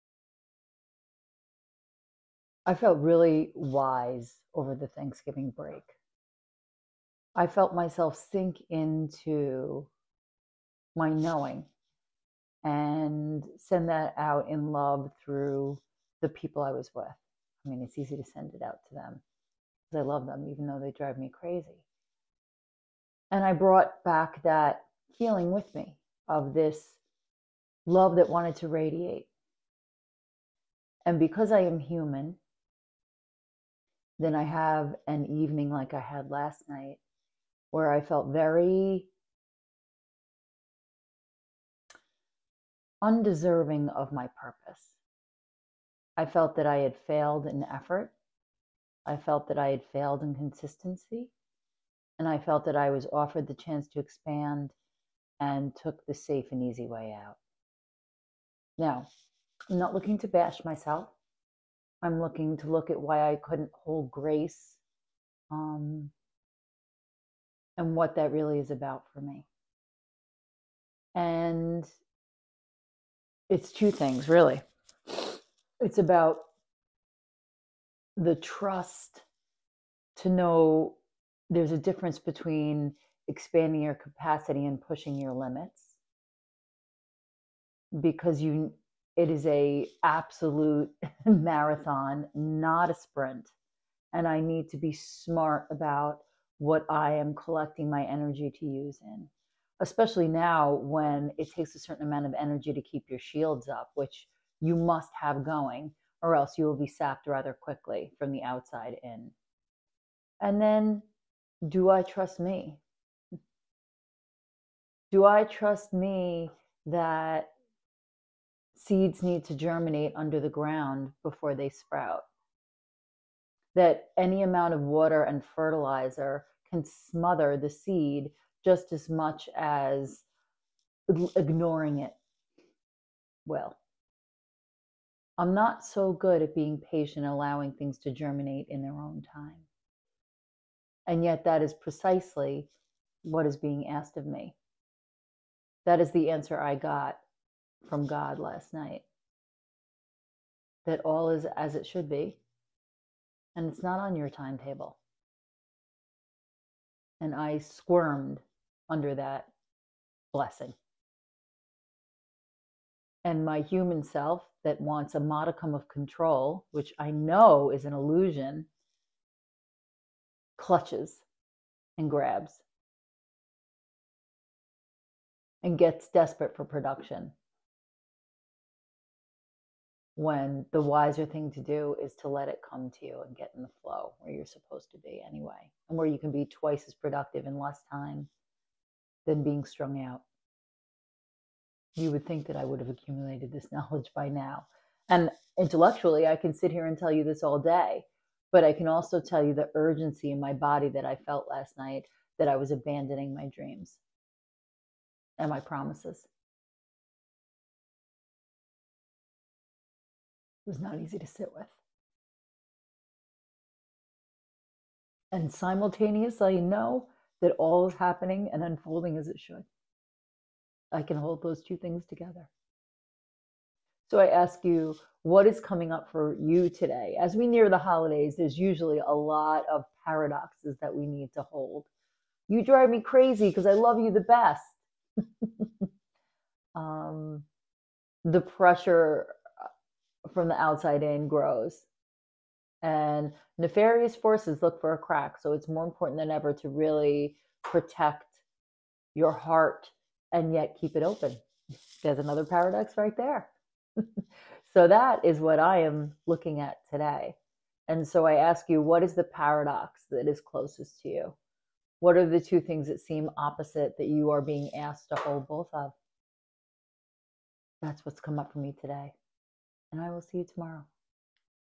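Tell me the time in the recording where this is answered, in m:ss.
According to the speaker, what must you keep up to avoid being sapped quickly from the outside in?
1:43.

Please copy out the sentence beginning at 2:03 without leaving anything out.
That any amount of water and fertilizer can smother the seed just as much as ignoring it will.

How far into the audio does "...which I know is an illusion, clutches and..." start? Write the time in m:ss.
2:46.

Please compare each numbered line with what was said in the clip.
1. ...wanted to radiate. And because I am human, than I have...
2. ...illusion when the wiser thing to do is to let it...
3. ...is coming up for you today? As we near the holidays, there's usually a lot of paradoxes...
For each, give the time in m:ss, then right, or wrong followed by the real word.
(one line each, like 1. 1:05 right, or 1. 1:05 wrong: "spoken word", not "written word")
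1. 0:28 right
2. 2:56 wrong: "production", not "illusion"
3. 3:45 right.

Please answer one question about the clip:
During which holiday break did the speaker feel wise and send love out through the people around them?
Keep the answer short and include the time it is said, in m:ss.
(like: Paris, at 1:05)
Thanksgiving, at 0:04.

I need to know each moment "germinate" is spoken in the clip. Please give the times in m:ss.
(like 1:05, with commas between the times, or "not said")
1:59, 2:18.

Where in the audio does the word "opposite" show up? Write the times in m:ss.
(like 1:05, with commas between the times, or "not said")
4:23.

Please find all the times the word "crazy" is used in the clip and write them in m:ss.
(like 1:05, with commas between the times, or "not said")
0:21, 3:53.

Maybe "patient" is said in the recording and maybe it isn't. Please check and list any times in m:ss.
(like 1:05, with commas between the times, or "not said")
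2:16.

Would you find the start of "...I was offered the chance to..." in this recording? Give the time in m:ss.
0:52.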